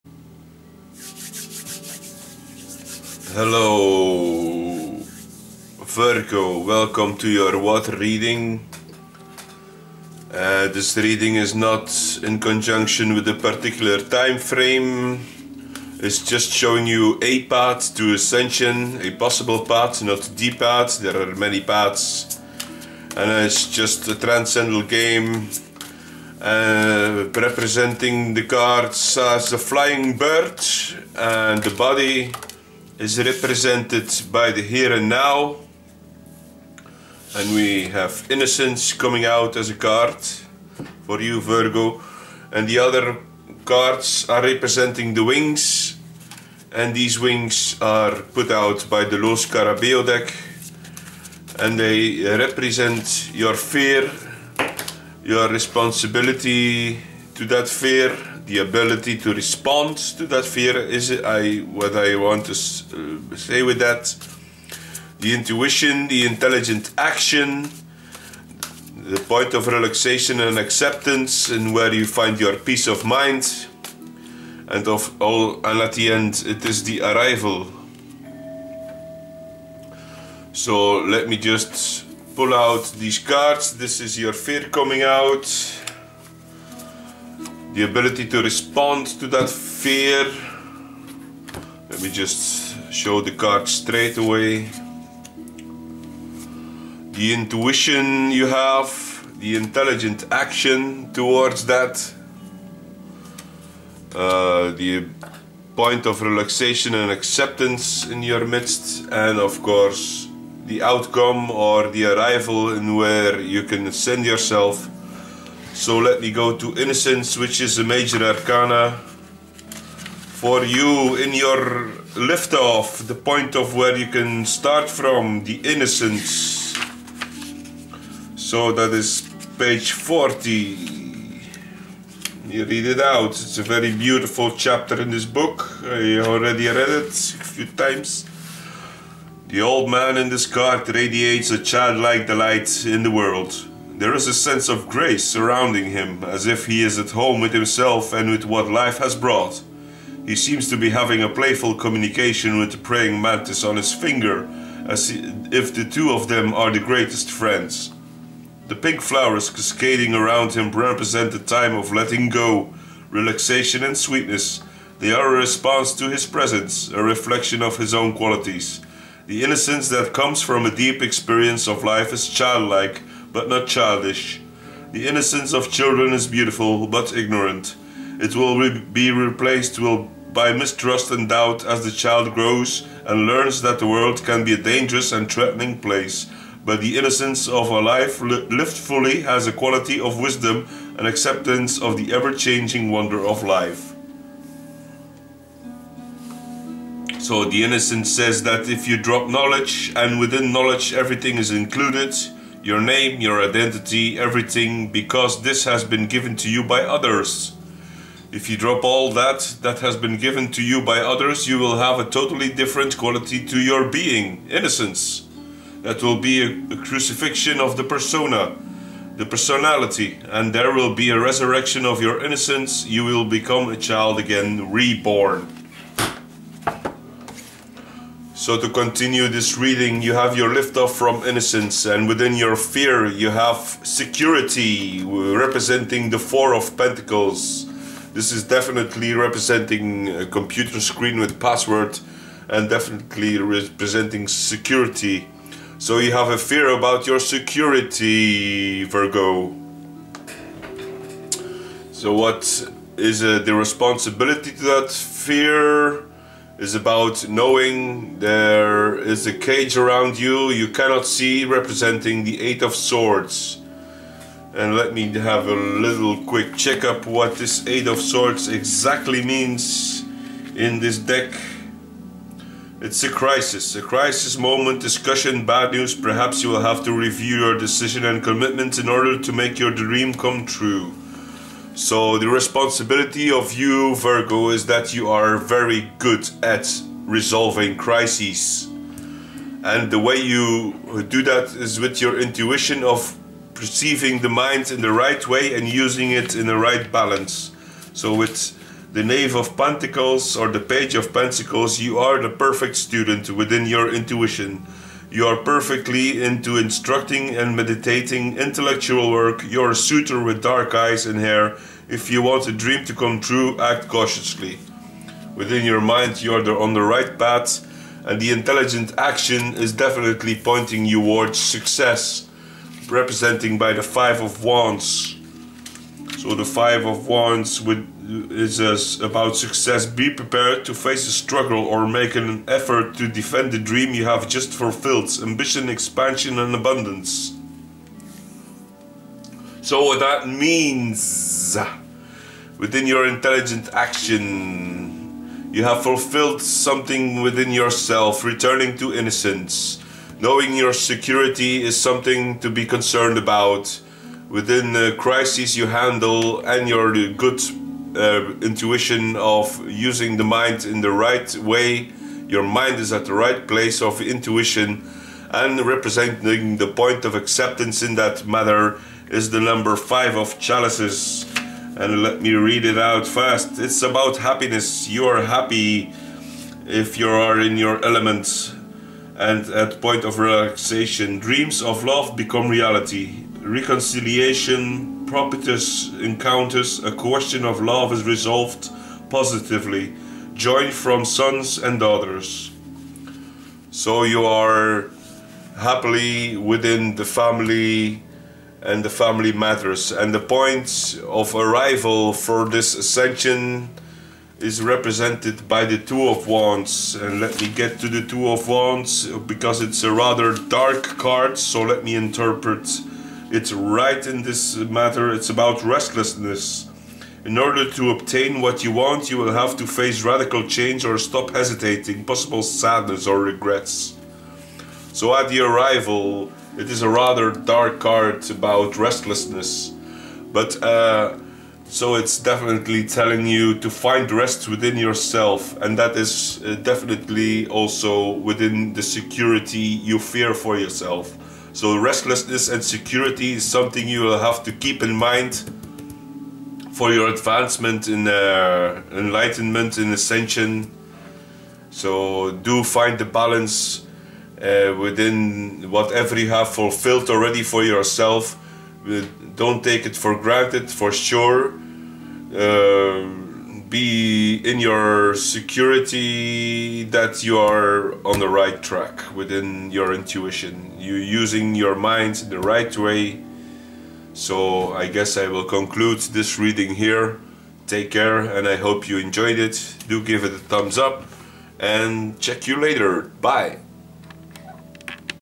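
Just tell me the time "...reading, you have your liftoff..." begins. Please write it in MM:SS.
03:49.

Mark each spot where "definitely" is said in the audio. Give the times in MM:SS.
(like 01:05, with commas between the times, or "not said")
03:58, 04:02, 05:19, 07:12, 07:16.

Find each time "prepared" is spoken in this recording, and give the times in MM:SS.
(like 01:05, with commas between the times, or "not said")
05:30.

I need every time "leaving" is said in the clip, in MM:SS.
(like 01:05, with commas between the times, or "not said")
not said.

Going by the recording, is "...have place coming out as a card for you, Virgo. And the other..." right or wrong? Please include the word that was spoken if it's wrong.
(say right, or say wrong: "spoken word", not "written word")
wrong: "innocence", not "place".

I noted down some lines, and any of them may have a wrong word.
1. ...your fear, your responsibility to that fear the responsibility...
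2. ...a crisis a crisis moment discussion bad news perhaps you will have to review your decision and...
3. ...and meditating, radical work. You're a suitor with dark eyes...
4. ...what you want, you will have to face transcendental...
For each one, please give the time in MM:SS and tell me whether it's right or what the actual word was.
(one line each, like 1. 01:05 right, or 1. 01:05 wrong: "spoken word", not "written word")
1. 00:53 wrong: "ability", not "responsibility"
2. 04:33 right
3. 05:07 wrong: "intellectual", not "radical"
4. 06:58 wrong: "radical", not "transcendental".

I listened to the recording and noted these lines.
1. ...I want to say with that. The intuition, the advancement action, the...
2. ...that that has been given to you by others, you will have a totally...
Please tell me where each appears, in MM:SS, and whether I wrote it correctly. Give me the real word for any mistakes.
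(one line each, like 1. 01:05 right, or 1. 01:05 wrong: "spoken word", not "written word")
1. 01:01 wrong: "intelligent", not "advancement"
2. 03:29 right.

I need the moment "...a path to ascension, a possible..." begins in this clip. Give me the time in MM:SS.
00:17.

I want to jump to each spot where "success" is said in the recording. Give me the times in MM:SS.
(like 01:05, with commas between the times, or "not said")
05:21, 05:29.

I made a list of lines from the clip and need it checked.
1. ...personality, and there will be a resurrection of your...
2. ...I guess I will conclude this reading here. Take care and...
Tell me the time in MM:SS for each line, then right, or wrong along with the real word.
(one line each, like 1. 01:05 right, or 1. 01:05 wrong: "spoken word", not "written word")
1. 03:39 right
2. 07:54 right.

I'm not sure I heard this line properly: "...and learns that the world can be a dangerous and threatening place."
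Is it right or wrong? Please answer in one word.
right.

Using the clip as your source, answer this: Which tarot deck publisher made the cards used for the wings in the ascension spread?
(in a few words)
Lo Scarabeo.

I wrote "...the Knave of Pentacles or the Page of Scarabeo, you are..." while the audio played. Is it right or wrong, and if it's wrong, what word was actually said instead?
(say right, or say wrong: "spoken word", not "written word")
wrong: "Pentacles", not "Scarabeo".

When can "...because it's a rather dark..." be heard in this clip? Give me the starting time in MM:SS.
06:49.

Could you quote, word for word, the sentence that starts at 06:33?
So you are happily within the family and the family matters.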